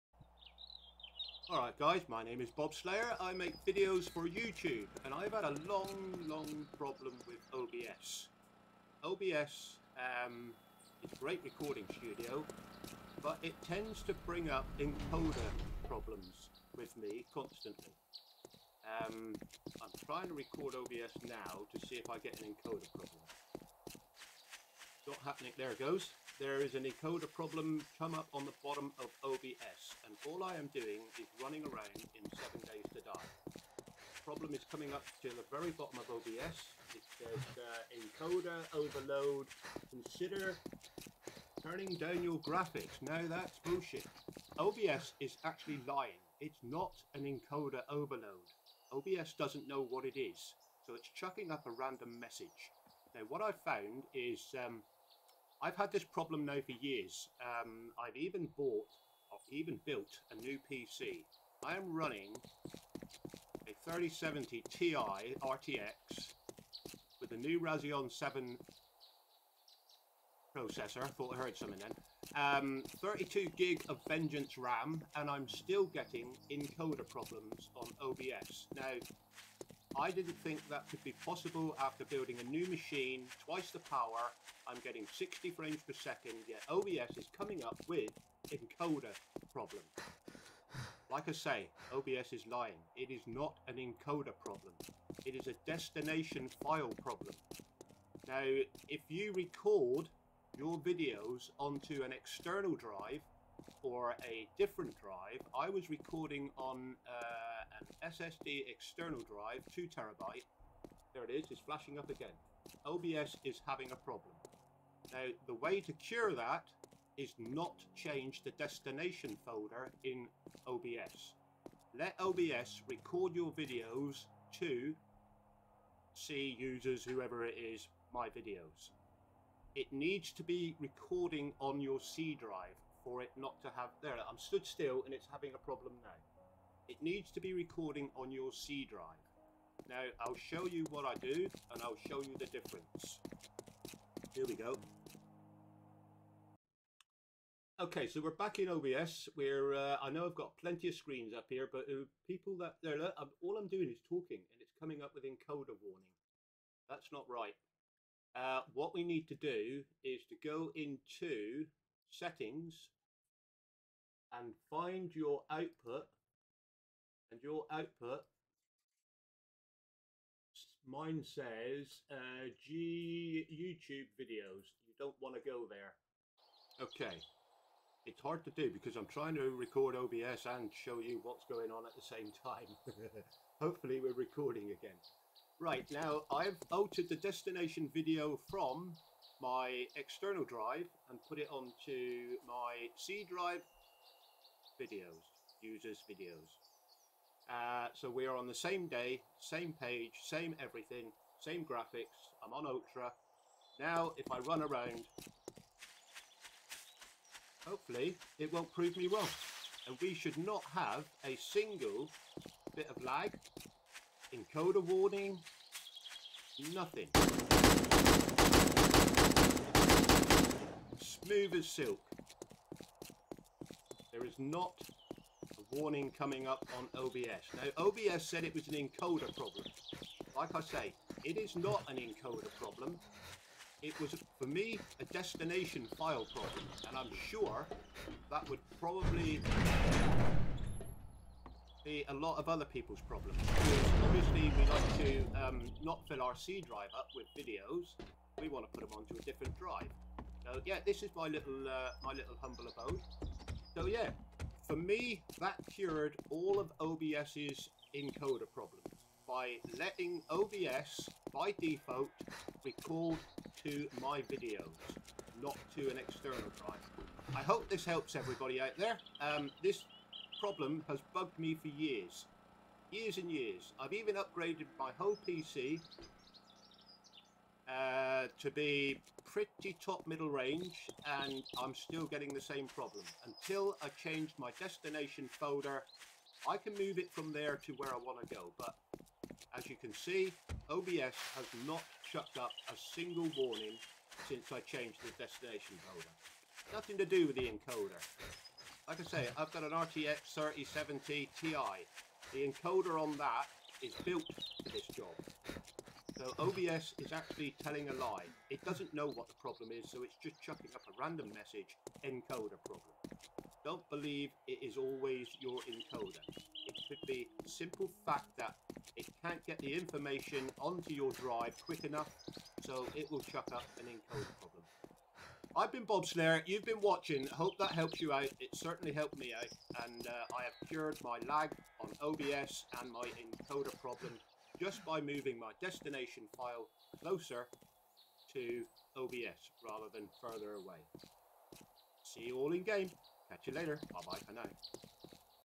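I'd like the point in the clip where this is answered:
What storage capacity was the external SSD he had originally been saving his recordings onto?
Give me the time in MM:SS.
01:49.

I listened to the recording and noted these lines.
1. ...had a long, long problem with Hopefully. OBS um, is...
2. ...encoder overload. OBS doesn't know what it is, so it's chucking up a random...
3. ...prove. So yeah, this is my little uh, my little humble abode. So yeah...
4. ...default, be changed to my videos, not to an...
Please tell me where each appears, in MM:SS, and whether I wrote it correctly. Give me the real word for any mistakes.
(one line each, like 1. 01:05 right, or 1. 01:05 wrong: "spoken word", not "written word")
1. 00:05 wrong: "OBS", not "Hopefully"
2. 00:47 right
3. 04:09 wrong: "drive", not "prove"
4. 04:21 wrong: "called", not "changed".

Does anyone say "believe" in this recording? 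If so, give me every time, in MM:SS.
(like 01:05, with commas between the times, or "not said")
05:13.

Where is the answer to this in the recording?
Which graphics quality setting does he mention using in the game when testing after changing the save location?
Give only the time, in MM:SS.
03:22.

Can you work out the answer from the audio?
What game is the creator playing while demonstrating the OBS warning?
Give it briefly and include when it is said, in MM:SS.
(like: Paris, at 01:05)
7 Days to Die, at 00:32.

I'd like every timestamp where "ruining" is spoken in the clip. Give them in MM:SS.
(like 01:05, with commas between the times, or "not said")
not said.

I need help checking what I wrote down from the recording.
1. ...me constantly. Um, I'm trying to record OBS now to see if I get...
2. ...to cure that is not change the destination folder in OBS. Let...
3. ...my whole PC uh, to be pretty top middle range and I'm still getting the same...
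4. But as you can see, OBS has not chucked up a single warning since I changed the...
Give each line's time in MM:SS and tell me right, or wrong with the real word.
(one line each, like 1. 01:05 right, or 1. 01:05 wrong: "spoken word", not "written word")
1. 00:16 right
2. 01:55 right
3. 04:34 right
4. 04:48 right.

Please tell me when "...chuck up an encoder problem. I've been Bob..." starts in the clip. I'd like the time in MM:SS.
05:23.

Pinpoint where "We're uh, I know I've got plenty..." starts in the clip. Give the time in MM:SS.
02:29.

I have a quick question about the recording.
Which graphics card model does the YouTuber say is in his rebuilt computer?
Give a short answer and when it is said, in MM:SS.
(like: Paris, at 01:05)
RTX 3070 Ti, at 01:03.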